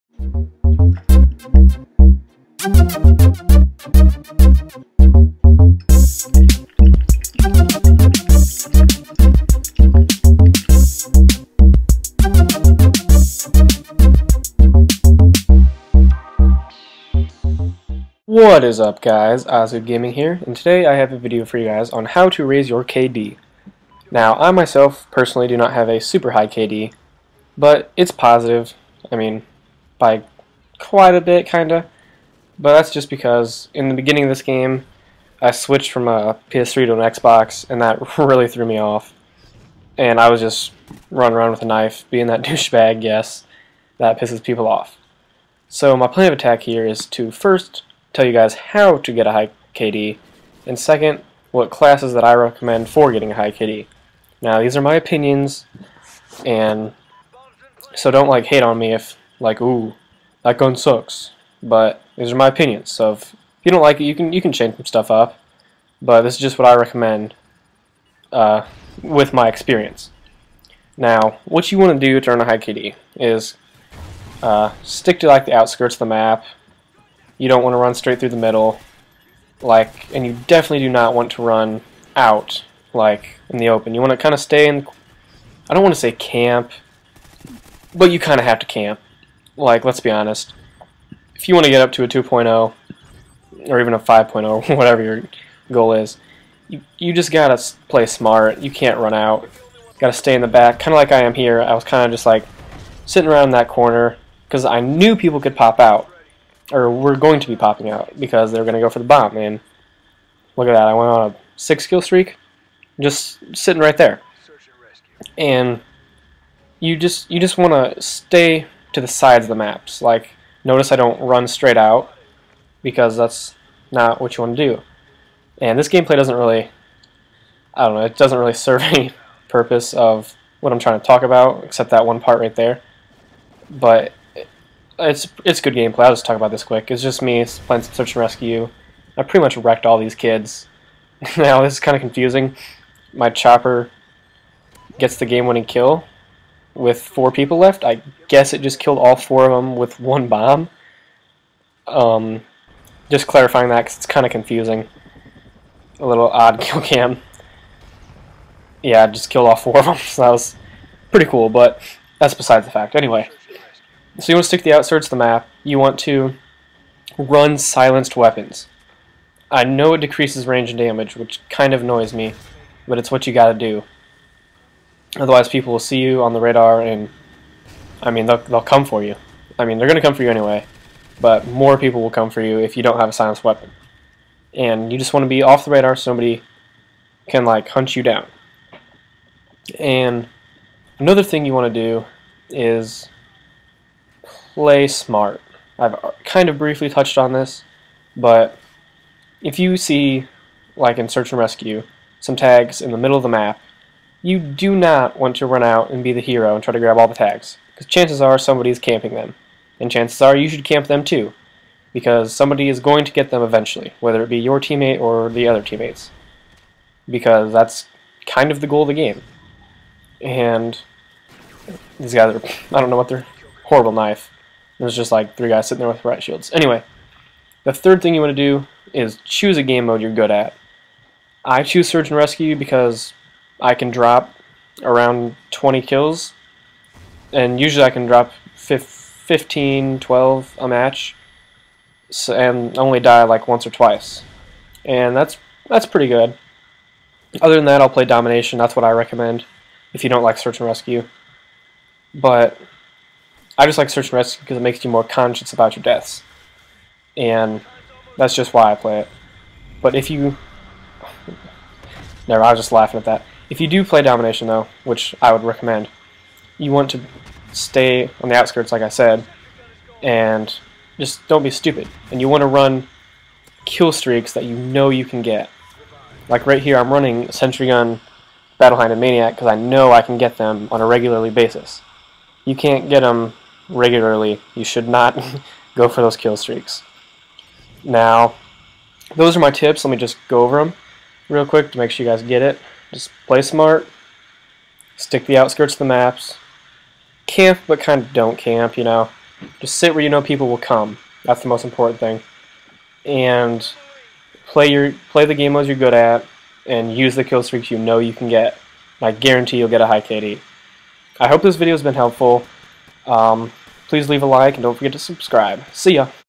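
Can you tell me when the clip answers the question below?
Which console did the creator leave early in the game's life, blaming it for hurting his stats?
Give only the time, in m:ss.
0:36.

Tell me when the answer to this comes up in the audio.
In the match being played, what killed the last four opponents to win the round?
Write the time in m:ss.
2:23.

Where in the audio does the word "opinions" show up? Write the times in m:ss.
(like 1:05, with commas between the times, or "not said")
0:54, 1:02.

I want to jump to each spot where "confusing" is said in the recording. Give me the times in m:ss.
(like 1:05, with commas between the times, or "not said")
2:22, 2:34.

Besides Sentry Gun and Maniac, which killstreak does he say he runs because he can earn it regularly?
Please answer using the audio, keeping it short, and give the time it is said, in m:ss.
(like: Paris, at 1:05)
Battlehound, at 4:38.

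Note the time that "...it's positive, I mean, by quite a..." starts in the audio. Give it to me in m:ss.
0:27.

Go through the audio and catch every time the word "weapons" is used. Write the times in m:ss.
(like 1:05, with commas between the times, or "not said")
2:48, 3:03.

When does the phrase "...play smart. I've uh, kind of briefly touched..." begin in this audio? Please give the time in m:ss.
3:14.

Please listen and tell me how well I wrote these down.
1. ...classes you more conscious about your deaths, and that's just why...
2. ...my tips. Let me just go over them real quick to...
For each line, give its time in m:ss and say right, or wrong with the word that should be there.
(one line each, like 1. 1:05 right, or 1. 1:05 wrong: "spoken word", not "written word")
1. 4:14 wrong: "makes", not "classes"
2. 4:49 right.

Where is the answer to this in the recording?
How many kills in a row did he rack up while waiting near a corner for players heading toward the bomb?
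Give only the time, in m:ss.
1:51.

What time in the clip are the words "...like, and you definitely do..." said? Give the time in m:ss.
1:19.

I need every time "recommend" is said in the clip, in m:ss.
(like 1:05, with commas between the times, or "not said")
0:52, 1:06, 4:08, 4:25.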